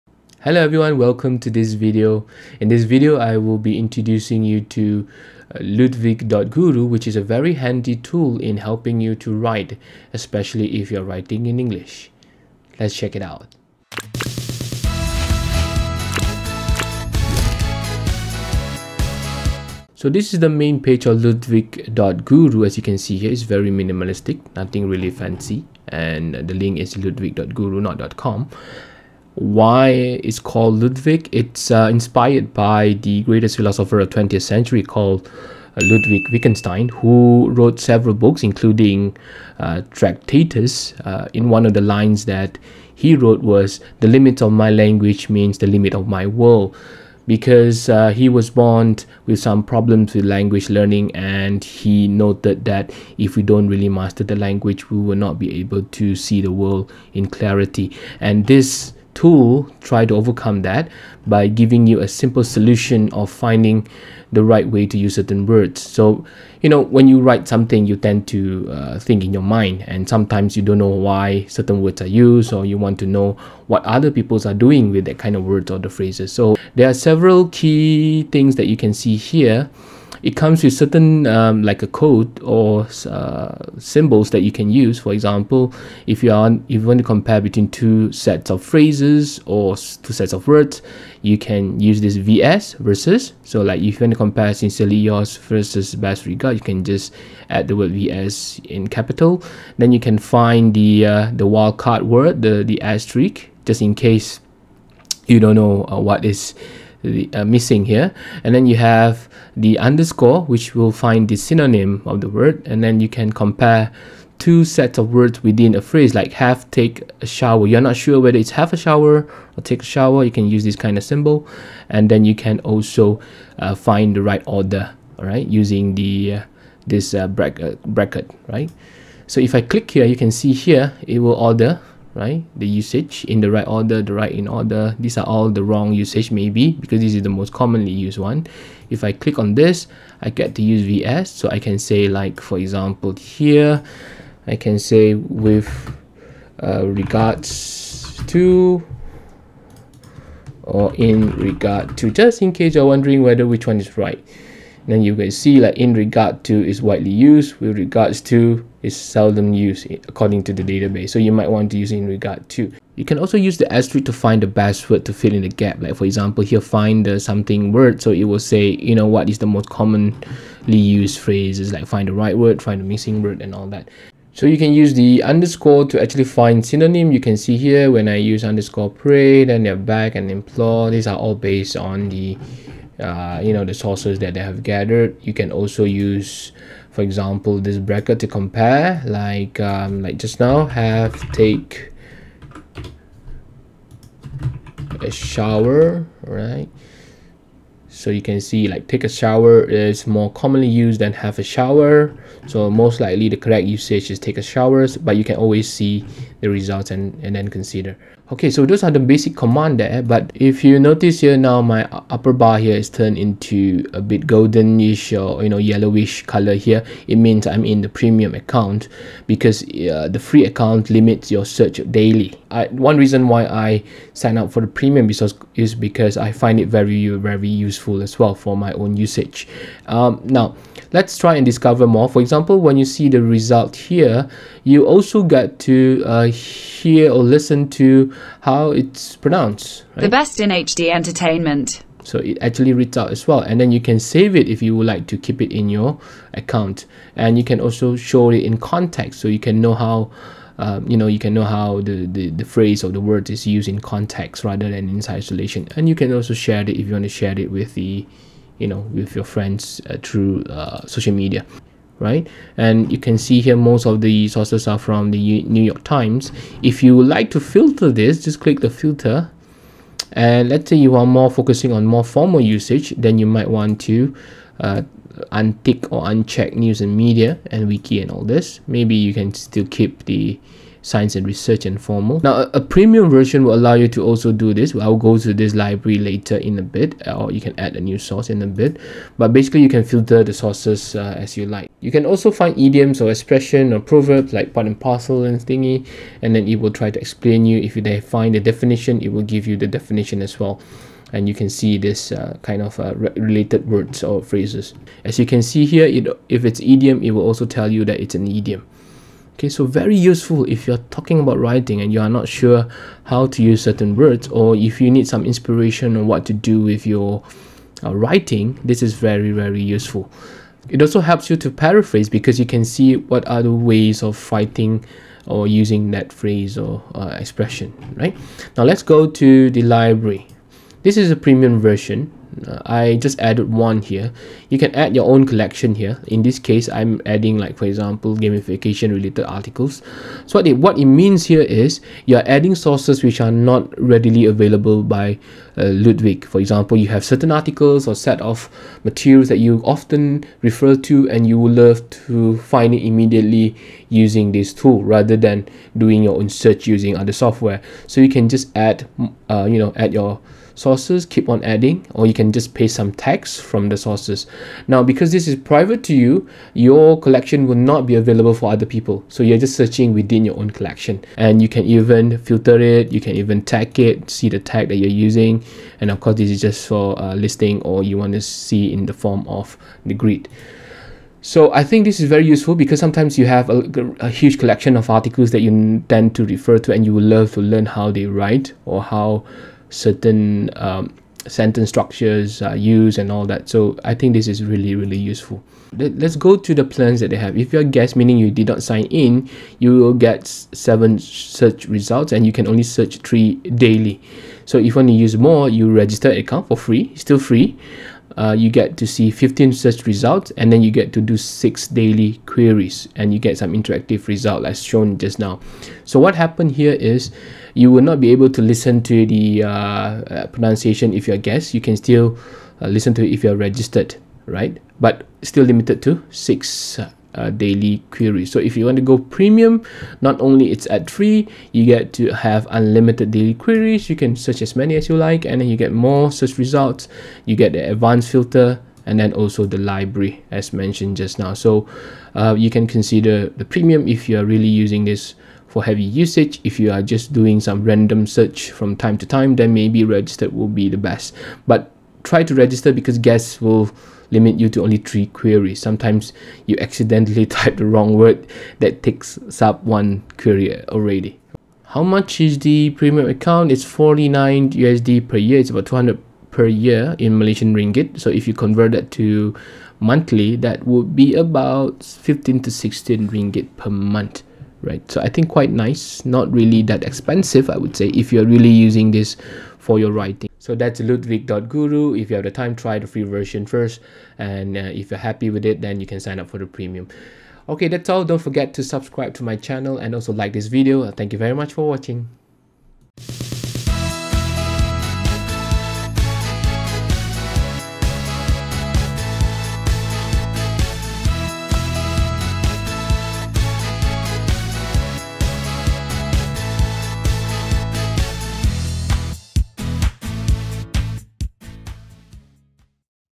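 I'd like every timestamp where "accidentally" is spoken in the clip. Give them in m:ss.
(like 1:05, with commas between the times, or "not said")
7:36.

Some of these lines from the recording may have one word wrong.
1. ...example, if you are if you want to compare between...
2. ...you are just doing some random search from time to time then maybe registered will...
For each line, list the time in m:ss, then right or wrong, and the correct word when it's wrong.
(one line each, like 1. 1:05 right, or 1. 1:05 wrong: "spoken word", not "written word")
1. 1:25 right
2. 7:26 right.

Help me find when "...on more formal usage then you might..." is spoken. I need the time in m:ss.
4:31.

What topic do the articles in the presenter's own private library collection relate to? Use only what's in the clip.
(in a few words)
gamification.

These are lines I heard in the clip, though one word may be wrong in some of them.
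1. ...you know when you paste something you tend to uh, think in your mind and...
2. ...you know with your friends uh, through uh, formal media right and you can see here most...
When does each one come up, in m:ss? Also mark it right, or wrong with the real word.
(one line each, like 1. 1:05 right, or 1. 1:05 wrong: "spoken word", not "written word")
1. 1:06 wrong: "write", not "paste"
2. 4:18 wrong: "social", not "formal".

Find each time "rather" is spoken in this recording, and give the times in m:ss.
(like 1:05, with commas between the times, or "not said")
4:14, 5:54.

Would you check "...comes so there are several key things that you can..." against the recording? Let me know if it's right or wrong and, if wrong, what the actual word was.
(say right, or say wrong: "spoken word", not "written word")
wrong: "phrases", not "comes".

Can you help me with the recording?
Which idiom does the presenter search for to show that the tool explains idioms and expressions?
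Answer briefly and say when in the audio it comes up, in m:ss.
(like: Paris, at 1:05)
part and parcel, at 4:54.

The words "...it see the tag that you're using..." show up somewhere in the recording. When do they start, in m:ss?
6:13.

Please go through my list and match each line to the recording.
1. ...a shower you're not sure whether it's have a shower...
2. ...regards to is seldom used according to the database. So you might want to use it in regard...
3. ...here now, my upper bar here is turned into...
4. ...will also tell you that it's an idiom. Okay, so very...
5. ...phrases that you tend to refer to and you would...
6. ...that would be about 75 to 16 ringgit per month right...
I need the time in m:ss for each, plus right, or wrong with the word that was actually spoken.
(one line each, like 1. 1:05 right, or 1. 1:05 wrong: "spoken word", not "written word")
1. 1:57 right
2. 2:37 right
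3. 3:31 right
4. 5:07 right
5. 6:24 wrong: "articles", not "phrases"
6. 7:50 wrong: "15", not "75".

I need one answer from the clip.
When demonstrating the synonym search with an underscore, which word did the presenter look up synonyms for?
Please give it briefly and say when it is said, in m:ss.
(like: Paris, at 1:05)
pray, at 2:58.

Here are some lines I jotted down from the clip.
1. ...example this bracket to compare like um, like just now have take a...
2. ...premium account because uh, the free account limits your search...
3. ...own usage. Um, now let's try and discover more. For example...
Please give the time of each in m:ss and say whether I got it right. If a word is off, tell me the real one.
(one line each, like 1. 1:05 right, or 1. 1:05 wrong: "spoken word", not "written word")
1. 3:07 right
2. 3:37 right
3. 3:48 right.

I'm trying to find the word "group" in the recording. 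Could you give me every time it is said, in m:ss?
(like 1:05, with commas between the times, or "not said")
not said.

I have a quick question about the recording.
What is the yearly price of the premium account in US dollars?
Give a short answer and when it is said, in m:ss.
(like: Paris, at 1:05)
49 USD, at 7:43.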